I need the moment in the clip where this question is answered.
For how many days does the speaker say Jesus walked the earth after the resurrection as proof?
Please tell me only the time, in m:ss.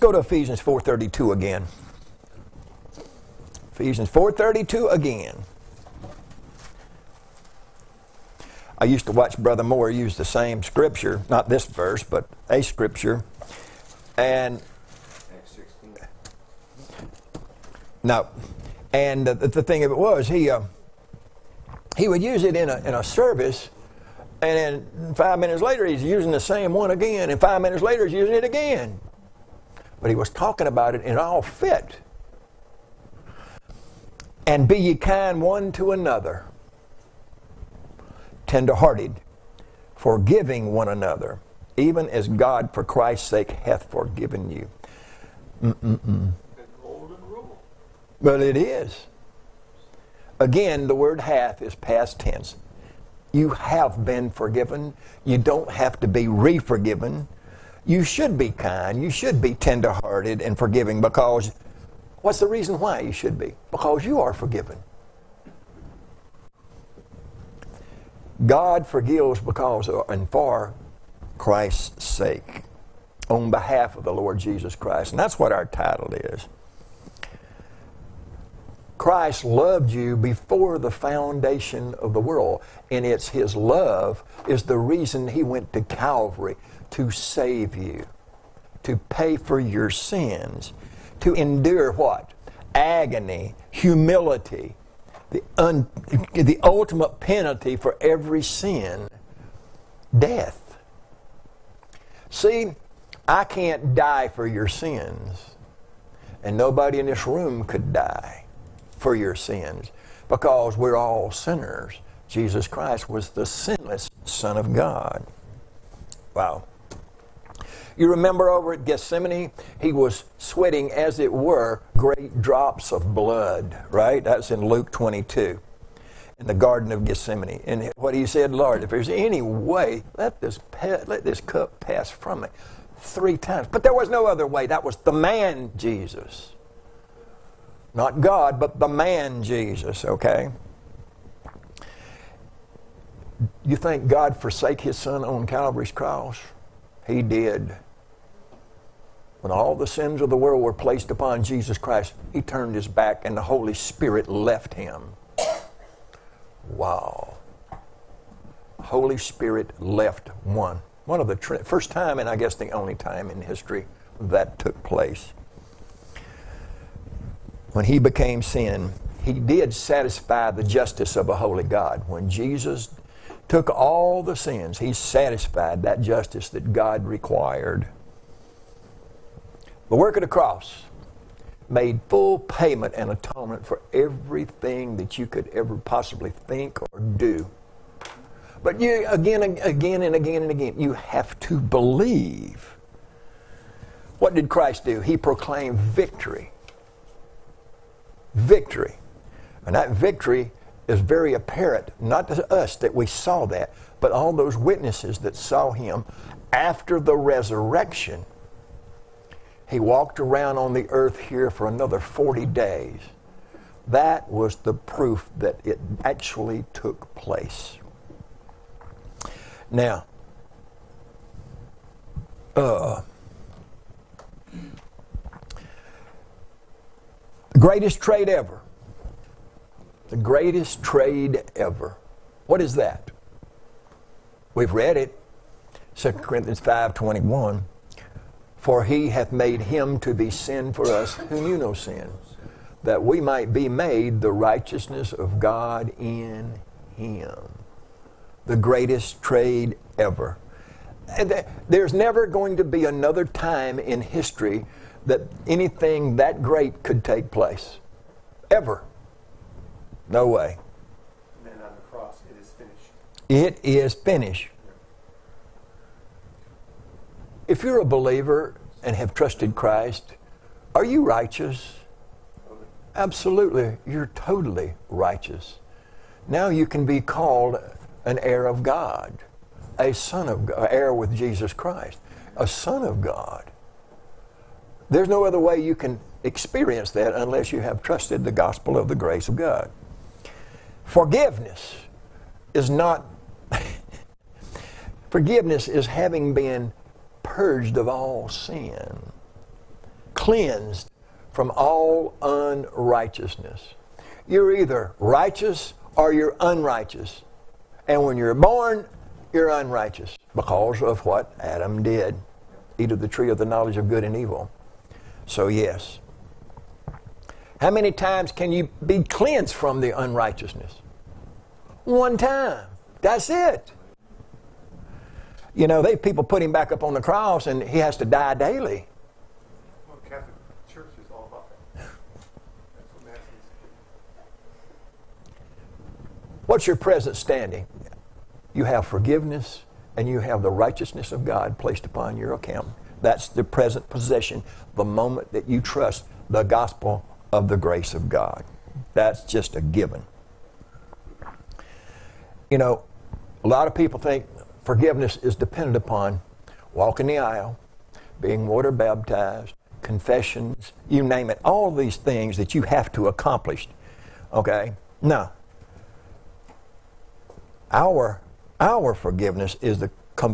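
3:31.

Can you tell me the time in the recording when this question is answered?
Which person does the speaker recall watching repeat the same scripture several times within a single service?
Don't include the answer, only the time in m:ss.
0:09.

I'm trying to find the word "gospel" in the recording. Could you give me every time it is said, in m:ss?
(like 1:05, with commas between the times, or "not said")
4:48, 5:46.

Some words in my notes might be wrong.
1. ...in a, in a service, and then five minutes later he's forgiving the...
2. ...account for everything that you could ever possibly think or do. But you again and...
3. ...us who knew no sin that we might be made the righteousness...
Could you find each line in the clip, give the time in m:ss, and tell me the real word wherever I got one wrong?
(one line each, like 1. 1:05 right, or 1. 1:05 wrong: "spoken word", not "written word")
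1. 0:22 wrong: "using", not "forgiving"
2. 3:03 wrong: "atonement", not "account"
3. 4:00 right.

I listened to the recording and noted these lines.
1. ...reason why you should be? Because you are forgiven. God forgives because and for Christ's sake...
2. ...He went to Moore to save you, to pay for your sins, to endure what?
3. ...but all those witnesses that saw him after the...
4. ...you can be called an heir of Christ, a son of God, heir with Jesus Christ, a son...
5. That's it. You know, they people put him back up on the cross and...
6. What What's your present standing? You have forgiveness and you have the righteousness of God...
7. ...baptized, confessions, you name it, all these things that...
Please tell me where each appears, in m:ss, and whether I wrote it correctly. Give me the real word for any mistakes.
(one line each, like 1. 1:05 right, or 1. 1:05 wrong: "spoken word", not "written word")
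1. 1:02 right
2. 1:25 wrong: "Calvary", not "Moore"
3. 3:23 right
4. 4:36 wrong: "God", not "Christ"
5. 5:23 right
6. 5:33 right
7. 5:58 right.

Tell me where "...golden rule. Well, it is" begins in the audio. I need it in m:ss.
0:46.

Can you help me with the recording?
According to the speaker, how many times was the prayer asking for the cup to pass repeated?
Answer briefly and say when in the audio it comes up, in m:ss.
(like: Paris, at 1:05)
3, at 2:12.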